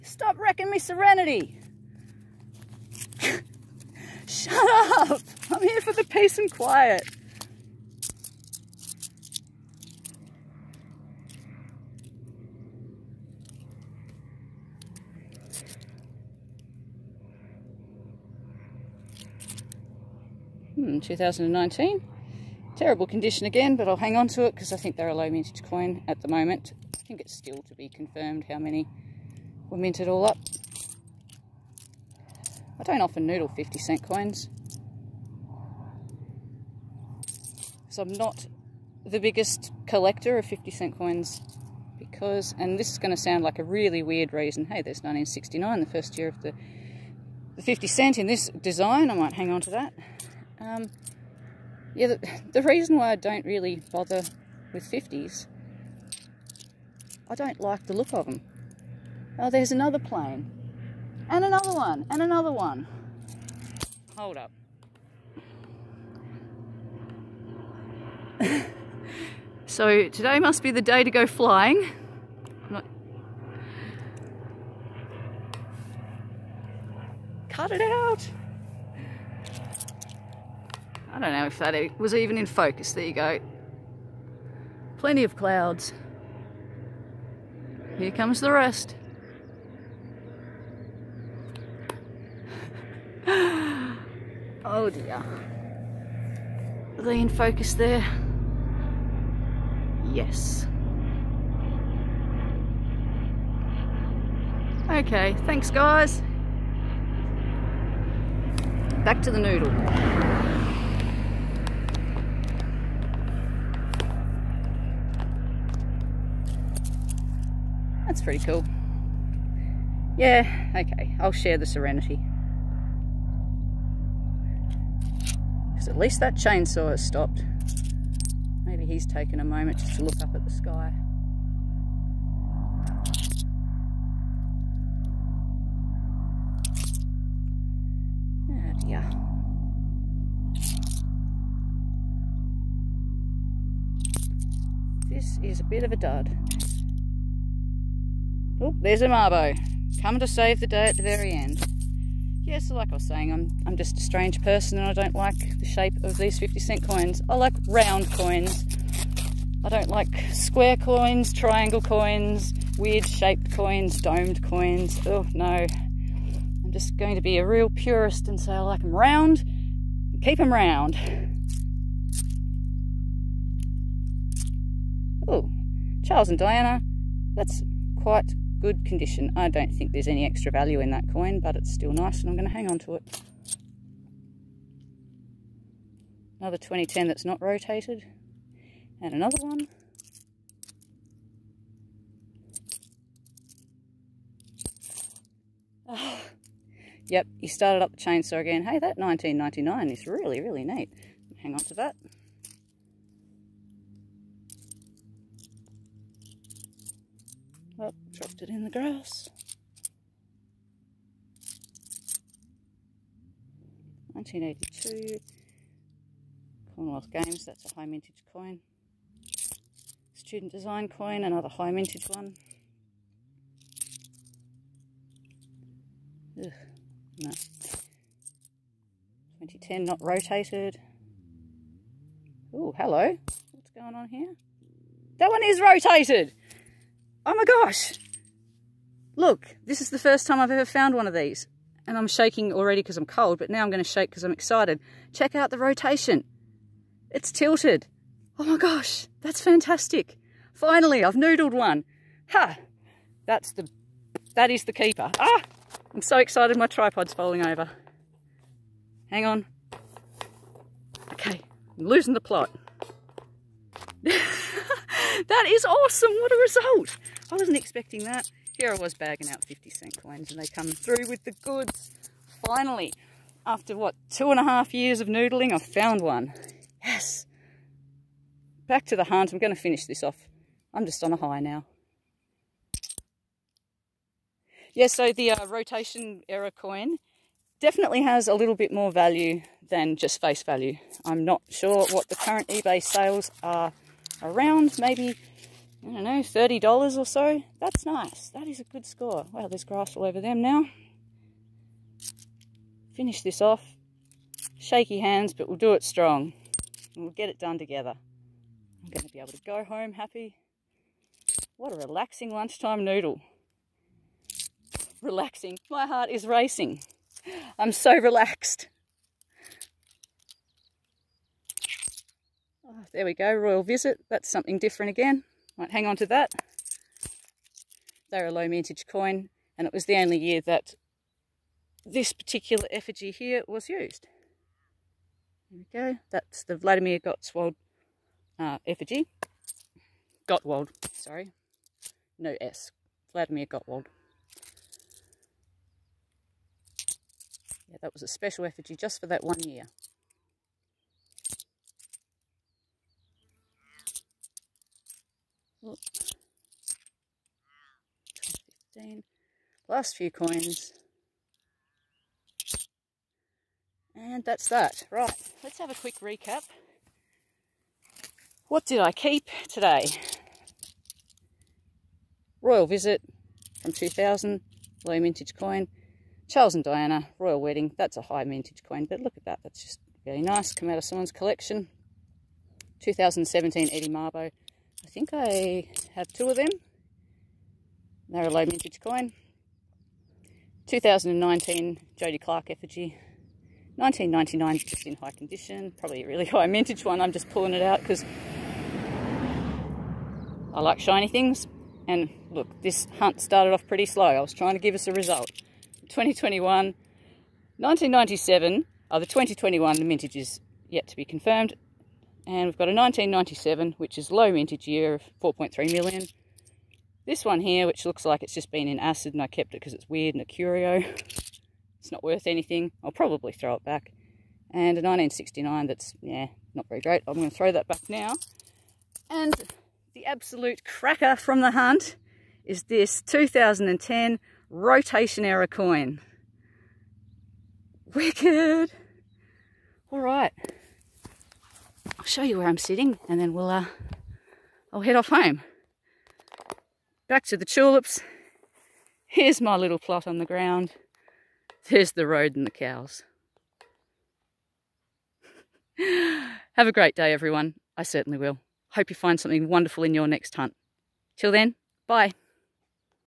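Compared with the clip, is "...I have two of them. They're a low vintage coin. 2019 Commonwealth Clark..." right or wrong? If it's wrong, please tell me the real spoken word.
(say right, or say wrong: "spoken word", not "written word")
wrong: "Jody", not "Commonwealth".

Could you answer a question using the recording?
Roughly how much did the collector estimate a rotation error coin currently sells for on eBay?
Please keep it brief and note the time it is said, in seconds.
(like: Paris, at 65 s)
$30, at 296 s.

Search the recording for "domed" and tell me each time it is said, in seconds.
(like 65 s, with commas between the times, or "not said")
164 s.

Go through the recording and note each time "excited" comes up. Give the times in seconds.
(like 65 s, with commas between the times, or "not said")
244 s, 256 s.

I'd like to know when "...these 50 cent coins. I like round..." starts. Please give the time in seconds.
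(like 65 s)
156 s.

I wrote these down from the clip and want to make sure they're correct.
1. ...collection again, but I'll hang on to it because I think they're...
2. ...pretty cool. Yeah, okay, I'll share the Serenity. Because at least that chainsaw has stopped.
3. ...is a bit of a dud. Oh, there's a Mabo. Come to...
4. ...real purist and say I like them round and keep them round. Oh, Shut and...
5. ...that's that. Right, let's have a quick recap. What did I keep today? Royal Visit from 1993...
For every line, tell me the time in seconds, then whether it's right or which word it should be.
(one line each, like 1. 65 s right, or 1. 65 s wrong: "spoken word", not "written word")
1. 23 s wrong: "condition", not "collection"
2. 118 s right
3. 145 s right
4. 167 s wrong: "Charles", not "Shut"
5. 364 s wrong: "2000", not "1993".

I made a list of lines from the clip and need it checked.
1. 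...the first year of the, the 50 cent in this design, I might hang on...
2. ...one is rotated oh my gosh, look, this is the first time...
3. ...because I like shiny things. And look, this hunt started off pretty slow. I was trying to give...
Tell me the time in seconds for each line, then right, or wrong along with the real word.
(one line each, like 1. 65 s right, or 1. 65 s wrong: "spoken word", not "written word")
1. 45 s right
2. 235 s right
3. 397 s right.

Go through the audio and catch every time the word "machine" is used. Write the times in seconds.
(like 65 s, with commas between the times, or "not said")
not said.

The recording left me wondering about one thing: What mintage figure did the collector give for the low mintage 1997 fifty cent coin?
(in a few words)
4.3 million.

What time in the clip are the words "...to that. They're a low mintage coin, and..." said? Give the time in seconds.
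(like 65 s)
325 s.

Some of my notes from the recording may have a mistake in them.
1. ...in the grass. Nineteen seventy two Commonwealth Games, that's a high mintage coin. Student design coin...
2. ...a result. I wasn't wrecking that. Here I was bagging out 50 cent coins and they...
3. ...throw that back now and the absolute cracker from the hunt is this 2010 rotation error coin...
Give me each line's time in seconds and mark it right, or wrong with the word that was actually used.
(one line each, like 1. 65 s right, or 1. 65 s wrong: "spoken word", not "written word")
1. 208 s wrong: "eighty", not "seventy"
2. 266 s wrong: "expecting", not "wrecking"
3. 427 s right.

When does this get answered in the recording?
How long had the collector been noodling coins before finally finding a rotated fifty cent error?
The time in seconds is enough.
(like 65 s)
274 s.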